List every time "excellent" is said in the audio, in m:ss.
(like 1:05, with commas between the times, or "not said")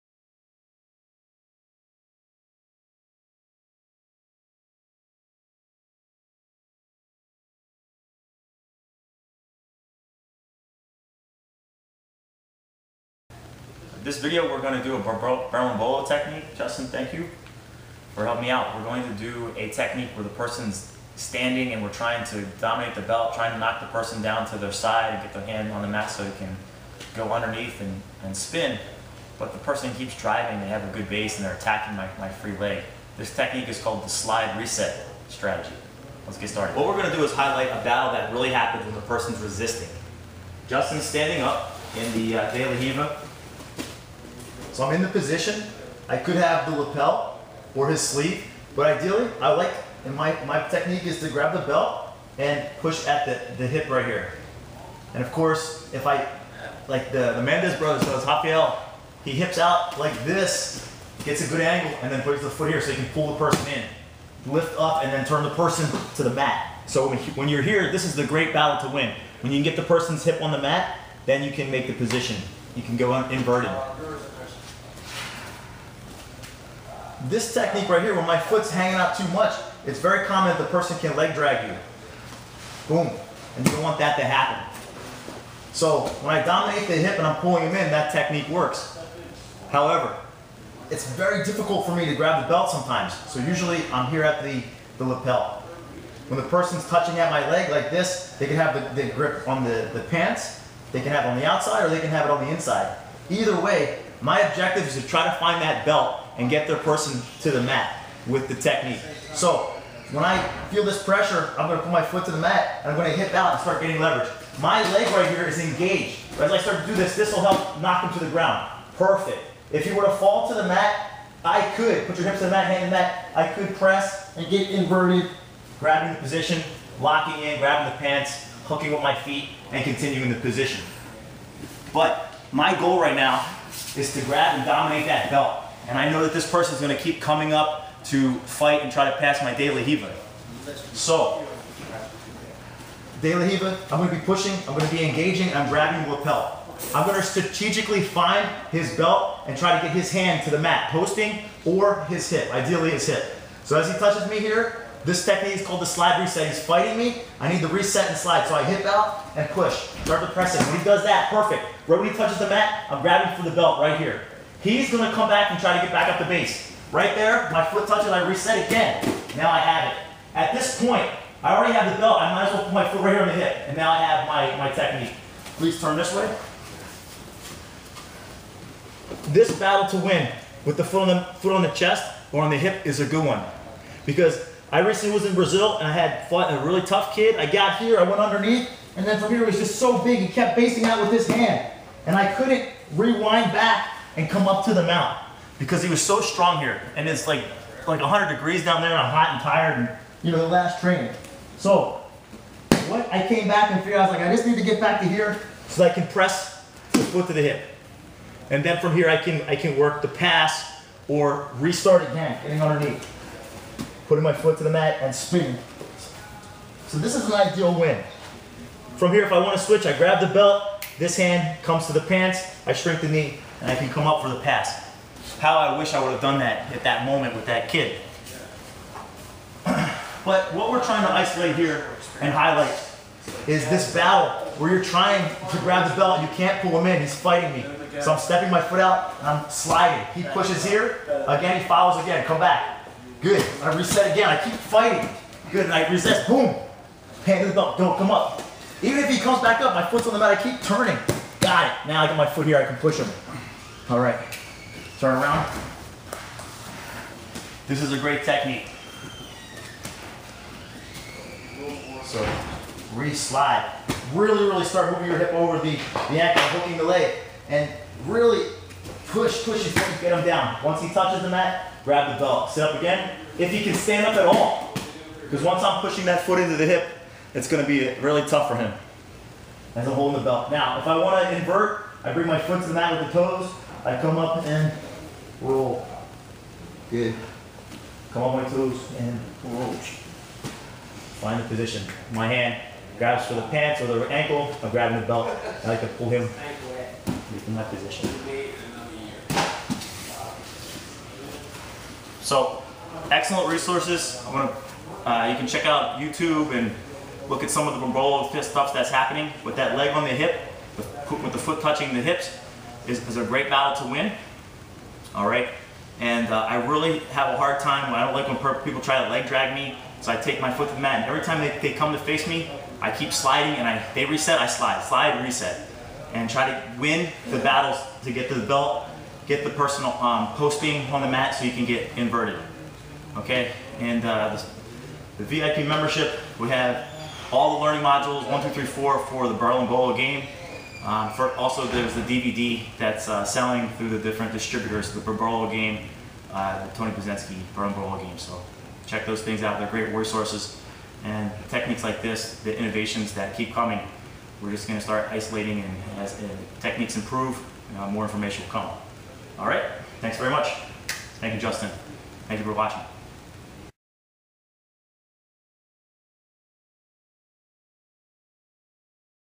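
5:03.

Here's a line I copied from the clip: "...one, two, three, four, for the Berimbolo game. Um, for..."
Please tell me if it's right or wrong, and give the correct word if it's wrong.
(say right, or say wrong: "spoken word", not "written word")
right.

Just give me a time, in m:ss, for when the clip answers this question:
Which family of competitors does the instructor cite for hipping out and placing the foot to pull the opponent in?
0:57.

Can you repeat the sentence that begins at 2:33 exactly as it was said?
So as he touches me here, this technique is called the slide reset.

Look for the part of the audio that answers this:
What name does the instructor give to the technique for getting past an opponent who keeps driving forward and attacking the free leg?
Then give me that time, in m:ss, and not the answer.
0:34.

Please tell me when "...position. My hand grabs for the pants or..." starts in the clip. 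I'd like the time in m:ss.
4:51.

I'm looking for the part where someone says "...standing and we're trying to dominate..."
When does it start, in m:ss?
0:21.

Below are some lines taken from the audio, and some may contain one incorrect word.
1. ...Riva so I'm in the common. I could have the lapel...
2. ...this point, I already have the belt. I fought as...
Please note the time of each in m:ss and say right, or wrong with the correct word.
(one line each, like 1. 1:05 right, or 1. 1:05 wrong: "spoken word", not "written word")
1. 0:42 wrong: "position", not "common"
2. 2:50 wrong: "might", not "fought".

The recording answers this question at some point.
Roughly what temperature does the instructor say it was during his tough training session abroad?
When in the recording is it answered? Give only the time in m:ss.
3:17.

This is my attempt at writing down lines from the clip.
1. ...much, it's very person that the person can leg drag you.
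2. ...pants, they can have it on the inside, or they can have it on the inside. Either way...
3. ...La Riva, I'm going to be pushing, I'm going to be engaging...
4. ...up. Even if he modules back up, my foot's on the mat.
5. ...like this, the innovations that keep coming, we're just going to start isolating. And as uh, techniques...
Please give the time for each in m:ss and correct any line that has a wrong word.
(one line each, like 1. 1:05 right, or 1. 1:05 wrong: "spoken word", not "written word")
1. 1:19 wrong: "common", not "person"
2. 1:40 wrong: "outside", not "inside"
3. 2:23 right
4. 4:08 wrong: "comes", not "modules"
5. 5:51 right.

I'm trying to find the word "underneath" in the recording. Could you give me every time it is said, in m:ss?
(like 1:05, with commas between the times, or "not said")
0:27, 3:08, 3:32.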